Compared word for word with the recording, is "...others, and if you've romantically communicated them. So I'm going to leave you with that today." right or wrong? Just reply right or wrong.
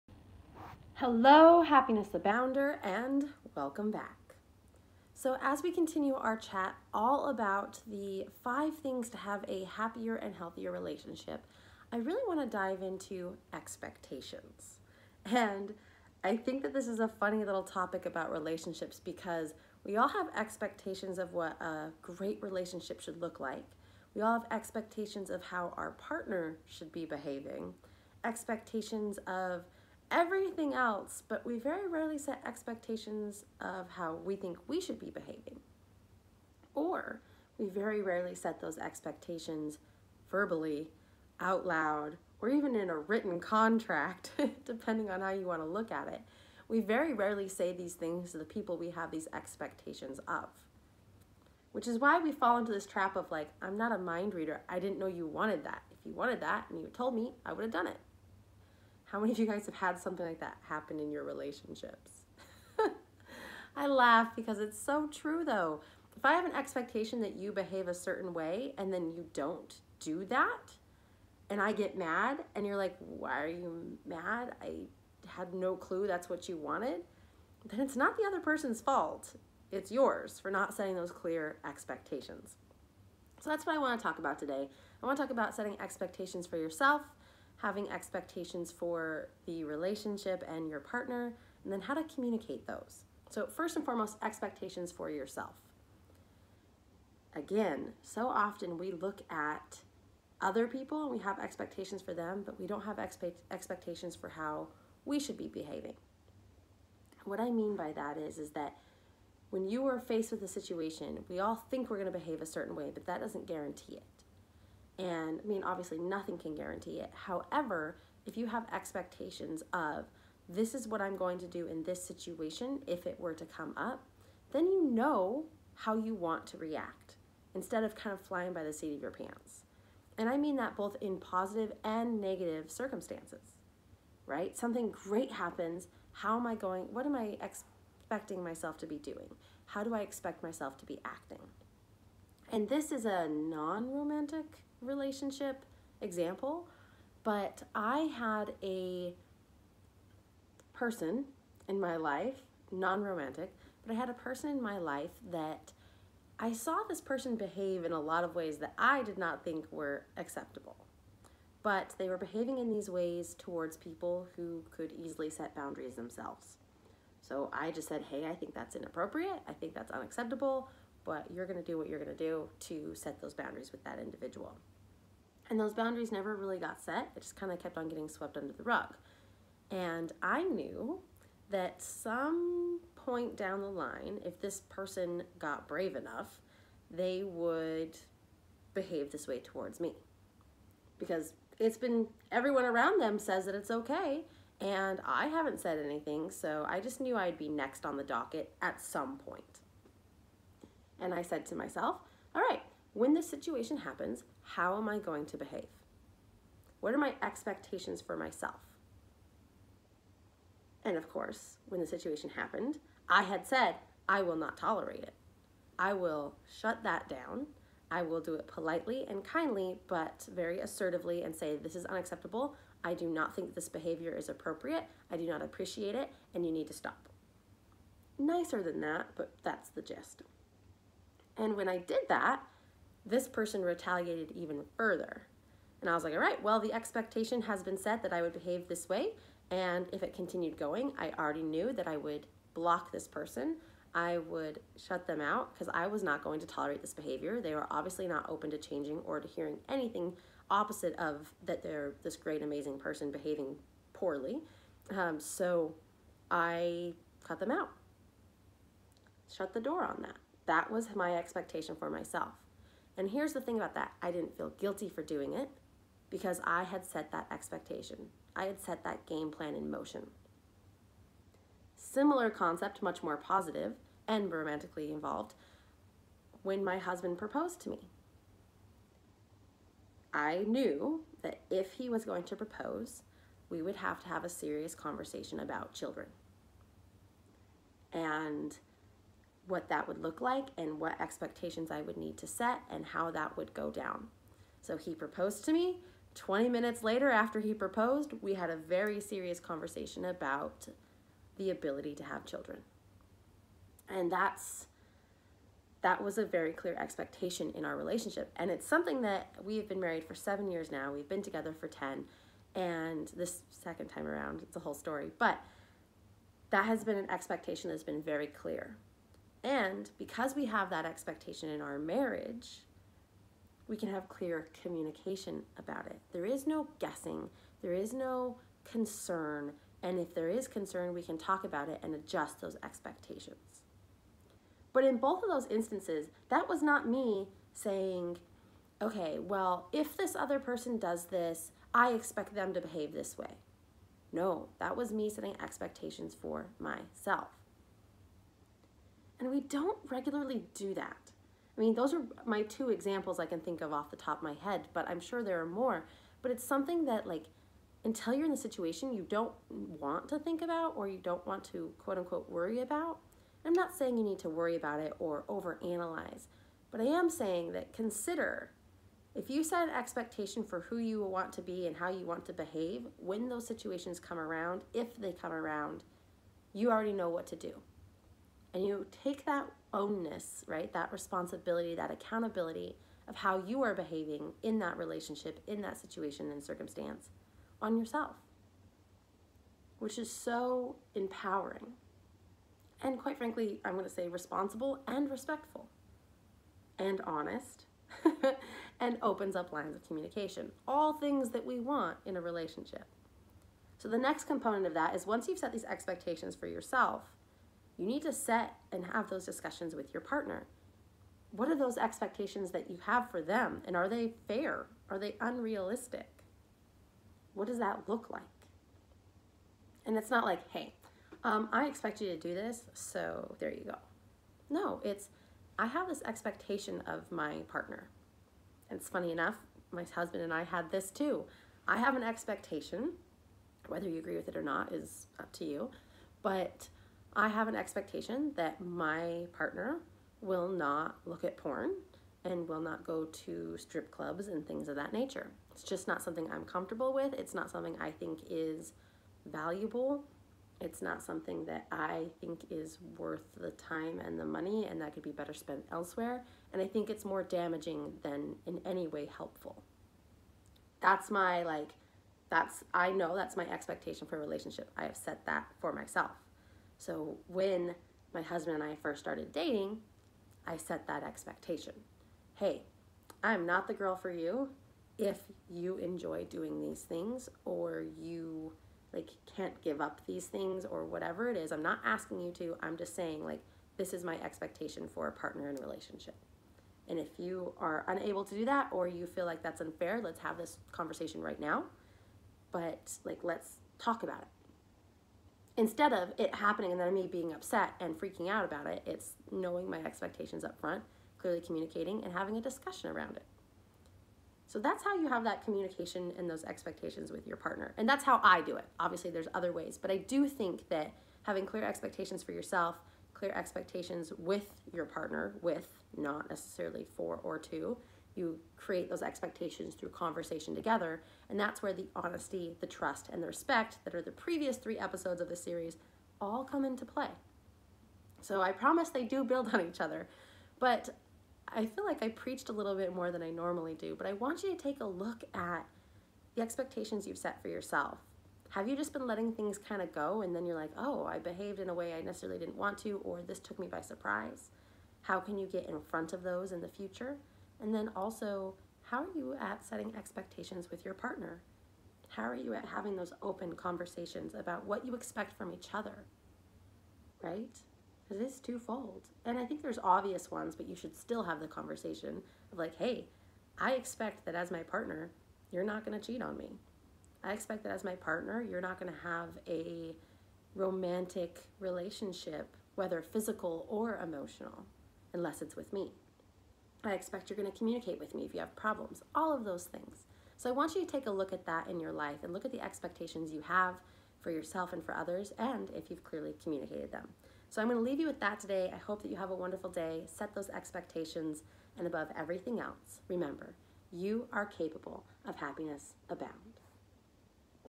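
wrong.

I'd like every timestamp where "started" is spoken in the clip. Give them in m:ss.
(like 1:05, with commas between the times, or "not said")
7:48.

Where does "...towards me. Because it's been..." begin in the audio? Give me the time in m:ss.
3:09.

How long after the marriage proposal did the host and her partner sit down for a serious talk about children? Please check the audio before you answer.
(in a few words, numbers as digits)
20 minutes.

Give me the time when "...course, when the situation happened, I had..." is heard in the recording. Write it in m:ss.
3:31.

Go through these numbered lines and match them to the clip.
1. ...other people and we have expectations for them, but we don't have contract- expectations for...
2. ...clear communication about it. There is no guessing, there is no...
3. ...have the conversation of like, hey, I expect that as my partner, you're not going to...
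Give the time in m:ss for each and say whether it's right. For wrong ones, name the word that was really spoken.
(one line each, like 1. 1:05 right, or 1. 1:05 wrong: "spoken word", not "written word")
1. 1:40 wrong: "expect", not "contract"
2. 5:24 right
3. 9:21 right.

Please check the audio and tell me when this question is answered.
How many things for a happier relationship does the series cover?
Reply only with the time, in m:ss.
0:08.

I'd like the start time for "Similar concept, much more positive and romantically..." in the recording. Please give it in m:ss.
4:31.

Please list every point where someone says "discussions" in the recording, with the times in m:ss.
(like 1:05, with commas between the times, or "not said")
6:49, 8:22.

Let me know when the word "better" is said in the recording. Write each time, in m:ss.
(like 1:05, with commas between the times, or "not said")
7:35.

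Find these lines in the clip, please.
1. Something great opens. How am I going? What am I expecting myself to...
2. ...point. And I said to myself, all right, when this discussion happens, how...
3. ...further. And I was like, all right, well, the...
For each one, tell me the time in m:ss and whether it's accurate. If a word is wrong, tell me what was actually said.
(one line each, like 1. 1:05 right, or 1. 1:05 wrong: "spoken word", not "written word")
1. 2:14 wrong: "happens", not "opens"
2. 3:19 wrong: "situation", not "discussion"
3. 3:54 right.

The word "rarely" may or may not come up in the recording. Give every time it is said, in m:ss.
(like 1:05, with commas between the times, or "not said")
0:31, 0:38, 0:47.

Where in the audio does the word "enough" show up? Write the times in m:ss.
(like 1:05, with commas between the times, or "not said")
3:05, 7:09.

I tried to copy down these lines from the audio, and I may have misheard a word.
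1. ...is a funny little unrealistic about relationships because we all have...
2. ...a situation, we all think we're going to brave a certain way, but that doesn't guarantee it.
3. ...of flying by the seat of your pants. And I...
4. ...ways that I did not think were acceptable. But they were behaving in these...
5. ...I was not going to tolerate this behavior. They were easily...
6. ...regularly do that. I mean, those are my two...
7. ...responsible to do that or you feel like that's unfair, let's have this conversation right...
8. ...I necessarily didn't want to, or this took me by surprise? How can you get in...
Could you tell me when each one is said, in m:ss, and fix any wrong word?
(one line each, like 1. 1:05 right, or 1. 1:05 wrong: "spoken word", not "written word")
1. 0:16 wrong: "topic", not "unrealistic"
2. 1:50 wrong: "behave", not "brave"
3. 2:08 right
4. 2:38 right
5. 4:05 wrong: "obviously", not "easily"
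6. 5:49 right
7. 8:07 wrong: "unable", not "responsible"
8. 9:01 right.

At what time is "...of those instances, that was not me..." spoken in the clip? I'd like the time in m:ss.
5:35.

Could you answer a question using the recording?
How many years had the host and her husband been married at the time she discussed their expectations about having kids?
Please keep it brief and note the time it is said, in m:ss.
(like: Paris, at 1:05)
7, at 5:10.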